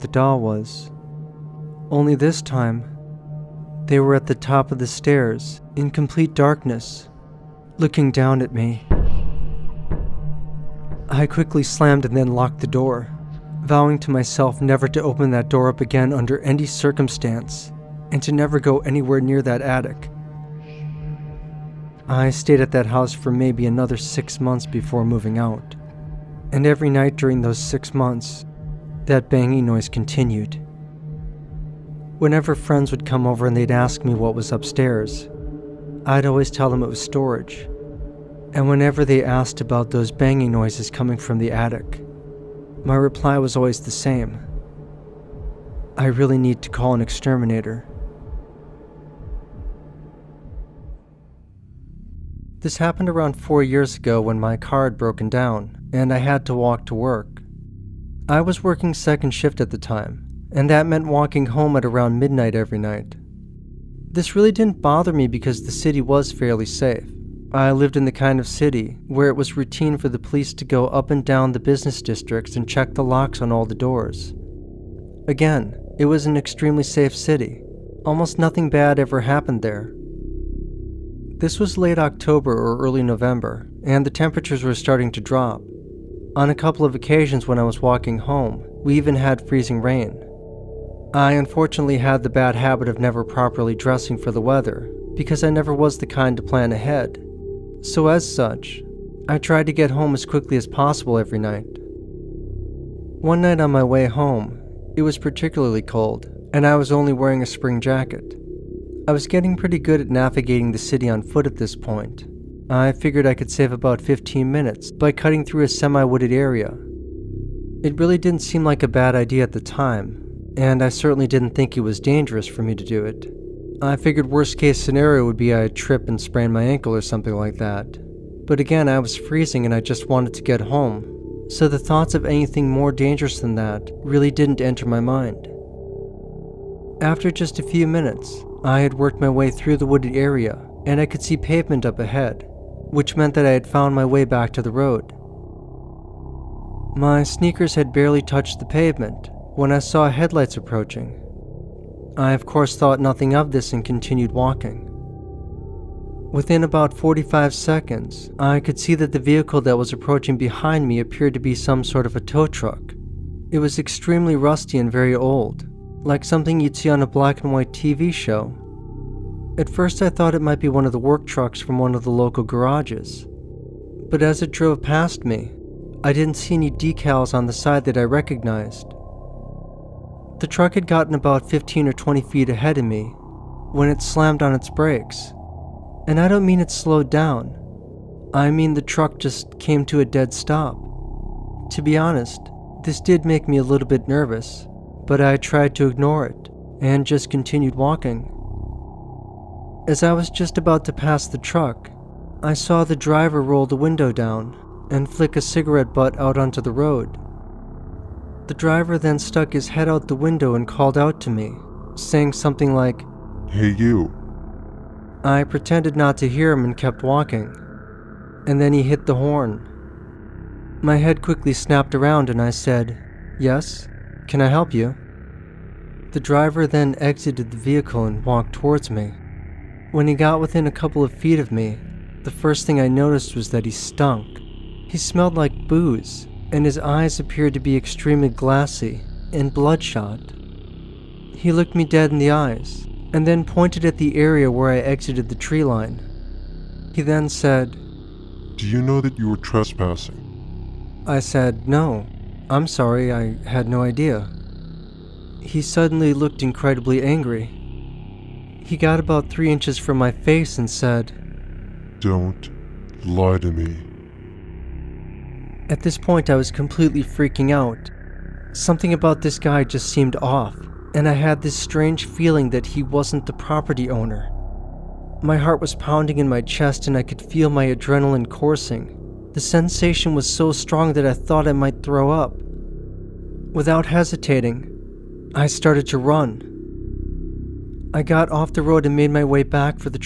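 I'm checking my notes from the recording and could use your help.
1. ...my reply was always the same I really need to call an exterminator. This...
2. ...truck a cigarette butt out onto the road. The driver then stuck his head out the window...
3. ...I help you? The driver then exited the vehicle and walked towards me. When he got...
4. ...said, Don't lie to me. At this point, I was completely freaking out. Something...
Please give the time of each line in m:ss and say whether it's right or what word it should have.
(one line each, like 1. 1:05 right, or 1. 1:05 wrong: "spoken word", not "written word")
1. 0:42 right
2. 3:25 wrong: "flick", not "truck"
3. 3:44 right
4. 4:20 right.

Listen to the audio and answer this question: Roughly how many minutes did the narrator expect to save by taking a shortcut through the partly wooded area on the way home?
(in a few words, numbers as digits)
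15.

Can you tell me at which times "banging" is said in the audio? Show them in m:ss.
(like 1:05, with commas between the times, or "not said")
0:29, 0:40.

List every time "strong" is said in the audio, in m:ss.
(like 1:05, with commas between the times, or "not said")
4:40.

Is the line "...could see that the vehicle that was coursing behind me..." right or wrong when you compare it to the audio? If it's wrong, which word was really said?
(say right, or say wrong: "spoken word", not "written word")
wrong: "approaching", not "coursing".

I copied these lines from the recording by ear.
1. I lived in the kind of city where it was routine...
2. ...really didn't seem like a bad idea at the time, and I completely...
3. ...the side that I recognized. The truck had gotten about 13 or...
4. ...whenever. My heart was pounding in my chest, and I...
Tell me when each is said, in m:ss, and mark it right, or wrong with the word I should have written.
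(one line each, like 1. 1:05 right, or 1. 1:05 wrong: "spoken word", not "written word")
1. 1:07 right
2. 1:58 wrong: "certainly", not "completely"
3. 2:57 wrong: "15", not "13"
4. 4:33 wrong: "owner", not "whenever".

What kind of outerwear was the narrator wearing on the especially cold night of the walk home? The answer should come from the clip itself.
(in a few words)
spring jacket.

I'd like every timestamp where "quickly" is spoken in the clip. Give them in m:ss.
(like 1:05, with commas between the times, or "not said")
0:11, 1:40, 3:41.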